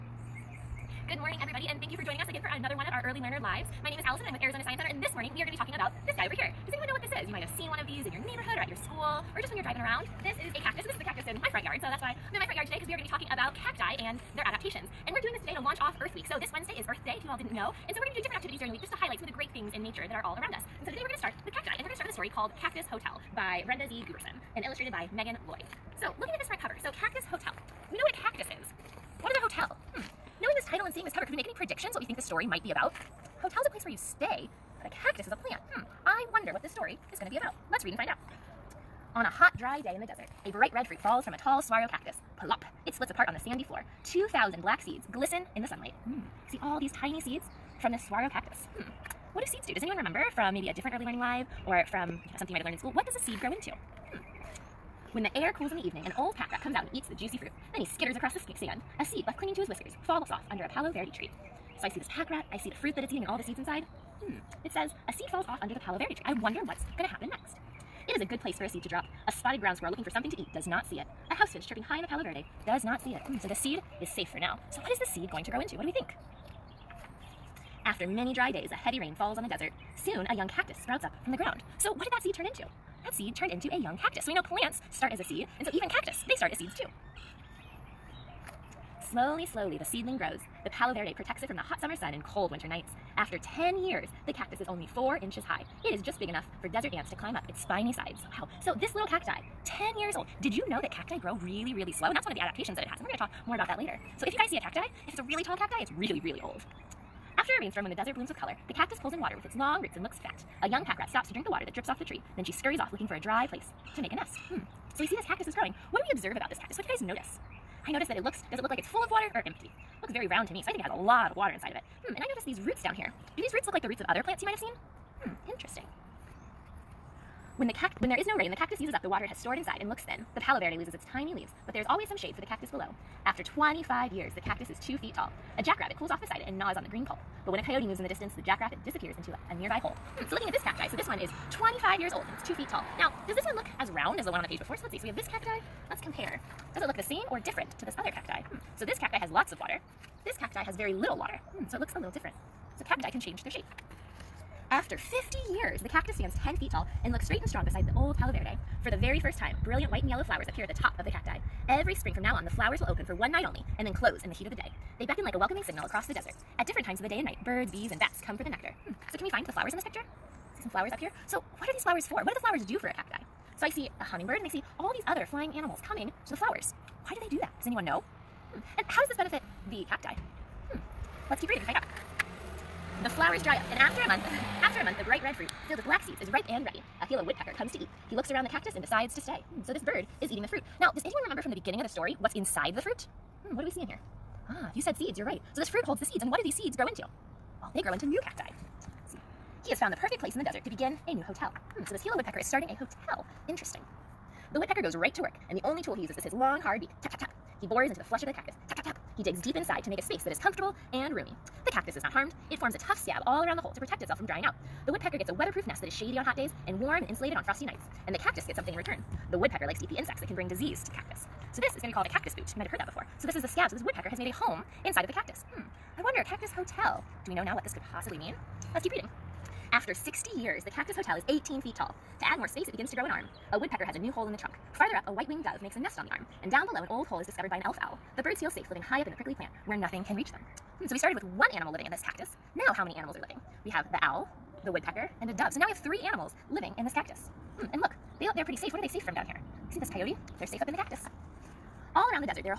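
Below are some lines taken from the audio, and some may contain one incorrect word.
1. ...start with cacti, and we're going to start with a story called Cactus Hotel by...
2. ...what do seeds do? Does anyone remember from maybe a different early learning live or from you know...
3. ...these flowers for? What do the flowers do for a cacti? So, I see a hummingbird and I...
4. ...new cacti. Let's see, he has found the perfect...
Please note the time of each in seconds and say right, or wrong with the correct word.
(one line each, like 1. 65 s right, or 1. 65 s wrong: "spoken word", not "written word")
1. 21 s right
2. 49 s right
3. 171 s right
4. 198 s right.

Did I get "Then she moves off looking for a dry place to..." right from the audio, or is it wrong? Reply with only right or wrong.
wrong.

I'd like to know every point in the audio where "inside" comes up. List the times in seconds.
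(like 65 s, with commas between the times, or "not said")
63 s, 121 s, 129 s, 192 s, 209 s, 224 s.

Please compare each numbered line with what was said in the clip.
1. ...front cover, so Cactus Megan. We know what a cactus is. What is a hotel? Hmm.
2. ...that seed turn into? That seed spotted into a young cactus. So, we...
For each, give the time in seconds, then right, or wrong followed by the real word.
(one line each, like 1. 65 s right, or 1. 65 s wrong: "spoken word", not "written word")
1. 26 s wrong: "Hotel", not "Megan"
2. 82 s wrong: "turned", not "spotted".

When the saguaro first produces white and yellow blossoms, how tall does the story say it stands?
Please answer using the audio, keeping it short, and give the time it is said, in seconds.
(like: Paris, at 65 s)
10 feet, at 156 s.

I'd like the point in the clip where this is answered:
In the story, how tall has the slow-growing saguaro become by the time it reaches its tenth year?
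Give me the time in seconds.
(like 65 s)
94 s.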